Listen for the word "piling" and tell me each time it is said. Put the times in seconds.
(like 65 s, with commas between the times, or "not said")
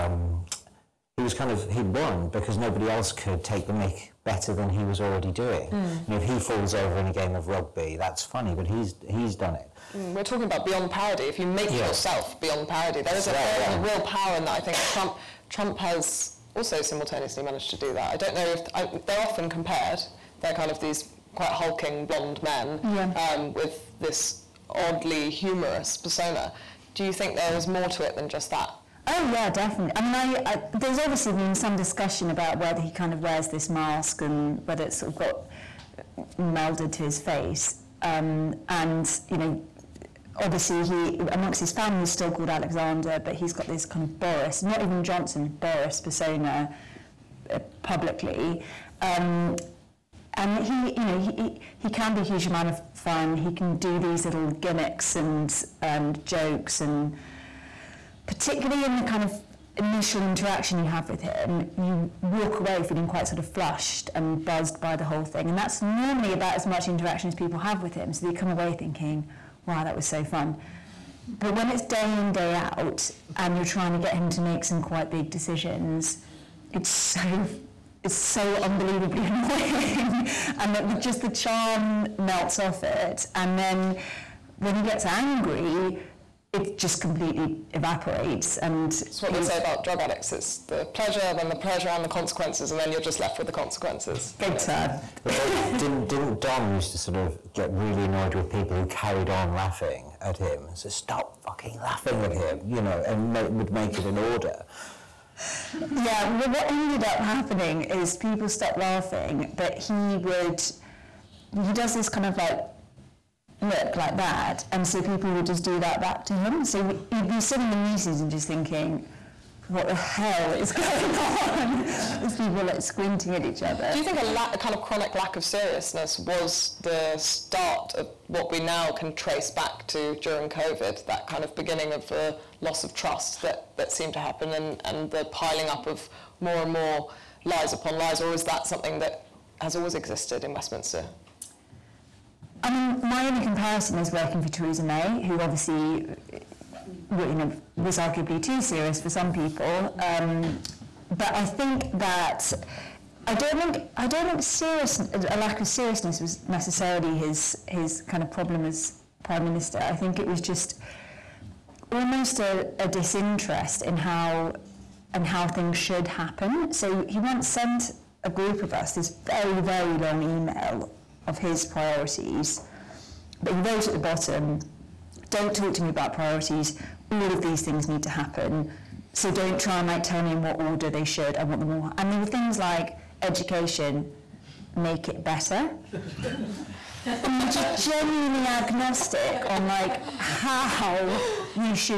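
135 s.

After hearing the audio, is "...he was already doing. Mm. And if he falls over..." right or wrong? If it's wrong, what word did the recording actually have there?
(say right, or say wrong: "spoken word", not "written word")
right.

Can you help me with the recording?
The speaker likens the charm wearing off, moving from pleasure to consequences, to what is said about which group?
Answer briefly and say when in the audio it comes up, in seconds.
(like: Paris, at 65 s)
drug addicts, at 89 s.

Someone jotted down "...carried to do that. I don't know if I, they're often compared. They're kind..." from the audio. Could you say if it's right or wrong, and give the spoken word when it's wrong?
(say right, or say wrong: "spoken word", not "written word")
wrong: "managed", not "carried".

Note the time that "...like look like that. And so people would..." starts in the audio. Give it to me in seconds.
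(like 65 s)
112 s.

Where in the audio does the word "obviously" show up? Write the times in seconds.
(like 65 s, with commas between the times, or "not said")
30 s, 40 s, 145 s.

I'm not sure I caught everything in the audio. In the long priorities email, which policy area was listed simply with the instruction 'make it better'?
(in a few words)
education.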